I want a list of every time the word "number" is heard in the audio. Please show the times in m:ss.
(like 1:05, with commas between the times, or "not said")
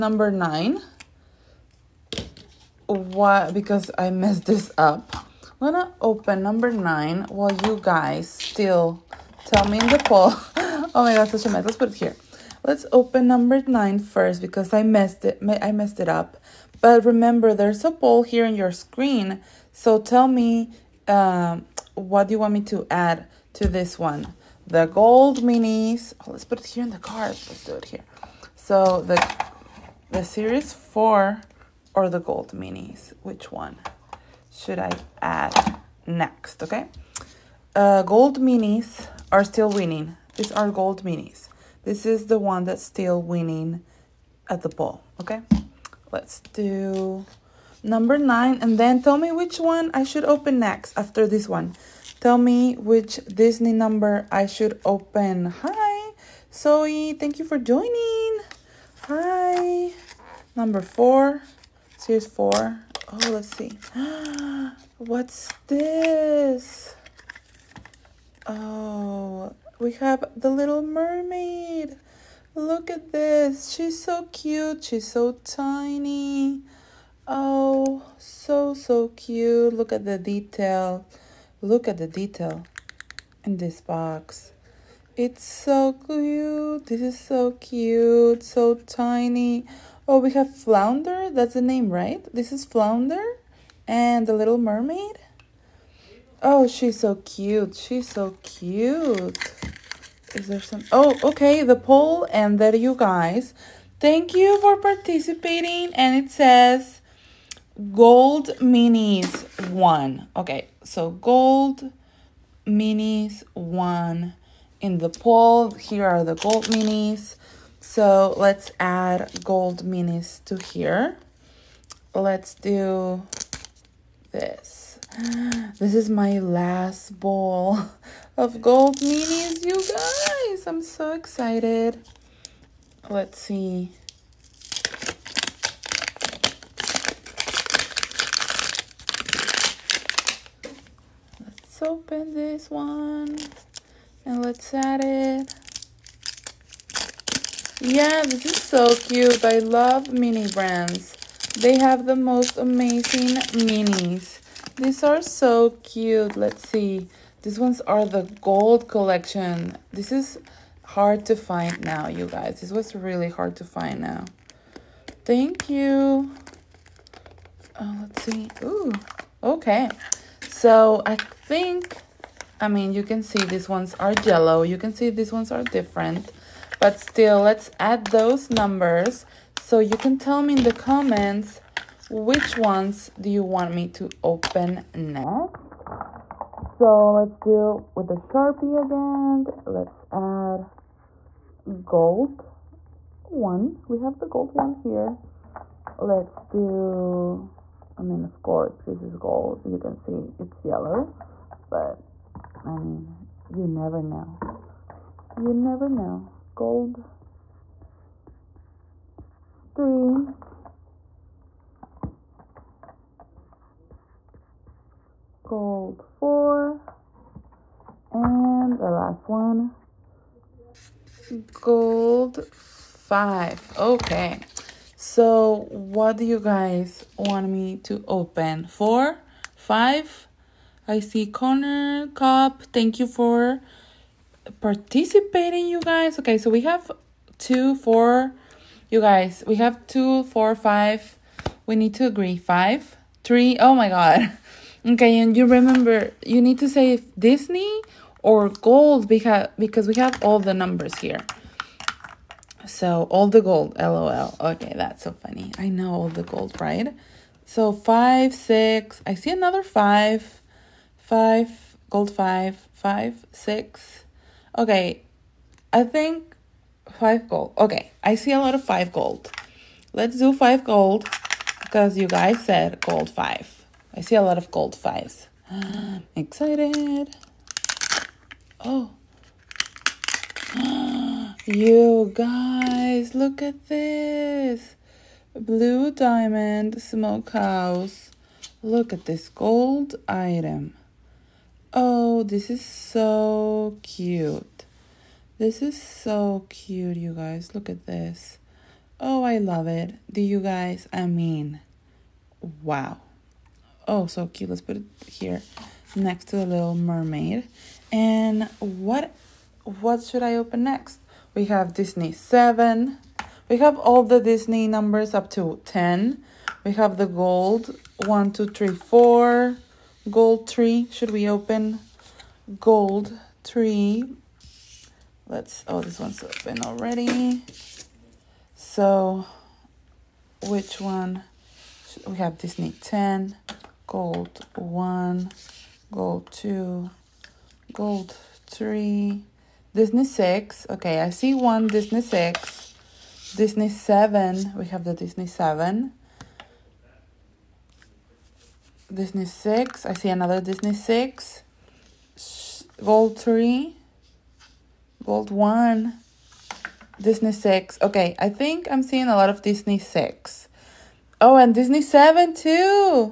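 0:06, 0:13, 0:47, 0:53, 1:00, 2:58, 4:10, 5:14.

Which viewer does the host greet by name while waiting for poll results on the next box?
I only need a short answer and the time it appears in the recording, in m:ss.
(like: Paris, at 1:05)
Zoe, at 0:56.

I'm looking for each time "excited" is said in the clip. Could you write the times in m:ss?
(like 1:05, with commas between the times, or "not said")
2:11, 4:36.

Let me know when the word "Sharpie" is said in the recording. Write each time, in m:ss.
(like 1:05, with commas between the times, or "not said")
3:08.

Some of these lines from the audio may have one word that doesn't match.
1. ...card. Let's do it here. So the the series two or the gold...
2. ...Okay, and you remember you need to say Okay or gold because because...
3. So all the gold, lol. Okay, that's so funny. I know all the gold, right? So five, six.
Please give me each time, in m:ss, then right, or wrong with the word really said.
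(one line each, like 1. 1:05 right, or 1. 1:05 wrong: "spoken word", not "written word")
1. 0:26 wrong: "four", not "two"
2. 4:04 wrong: "Disney", not "Okay"
3. 4:12 right.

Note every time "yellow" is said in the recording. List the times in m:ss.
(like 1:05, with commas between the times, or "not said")
2:54, 3:20.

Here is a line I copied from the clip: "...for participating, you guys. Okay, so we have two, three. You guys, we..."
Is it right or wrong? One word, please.
wrong.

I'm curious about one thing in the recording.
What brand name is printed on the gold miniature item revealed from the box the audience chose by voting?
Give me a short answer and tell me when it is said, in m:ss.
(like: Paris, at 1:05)
Blue Diamond Smokehouse, at 4:45.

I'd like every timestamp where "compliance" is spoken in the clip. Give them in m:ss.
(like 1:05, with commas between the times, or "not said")
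not said.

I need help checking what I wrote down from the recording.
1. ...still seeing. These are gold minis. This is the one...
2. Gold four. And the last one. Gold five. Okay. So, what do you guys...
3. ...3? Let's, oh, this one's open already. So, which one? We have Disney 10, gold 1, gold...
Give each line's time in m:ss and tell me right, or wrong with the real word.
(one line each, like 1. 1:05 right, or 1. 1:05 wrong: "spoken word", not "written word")
1. 0:39 wrong: "winning", not "seeing"
2. 3:35 right
3. 5:23 right.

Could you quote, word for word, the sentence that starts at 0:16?
But remember there's a poll here on your screen.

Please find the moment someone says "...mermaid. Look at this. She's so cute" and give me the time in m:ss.
1:10.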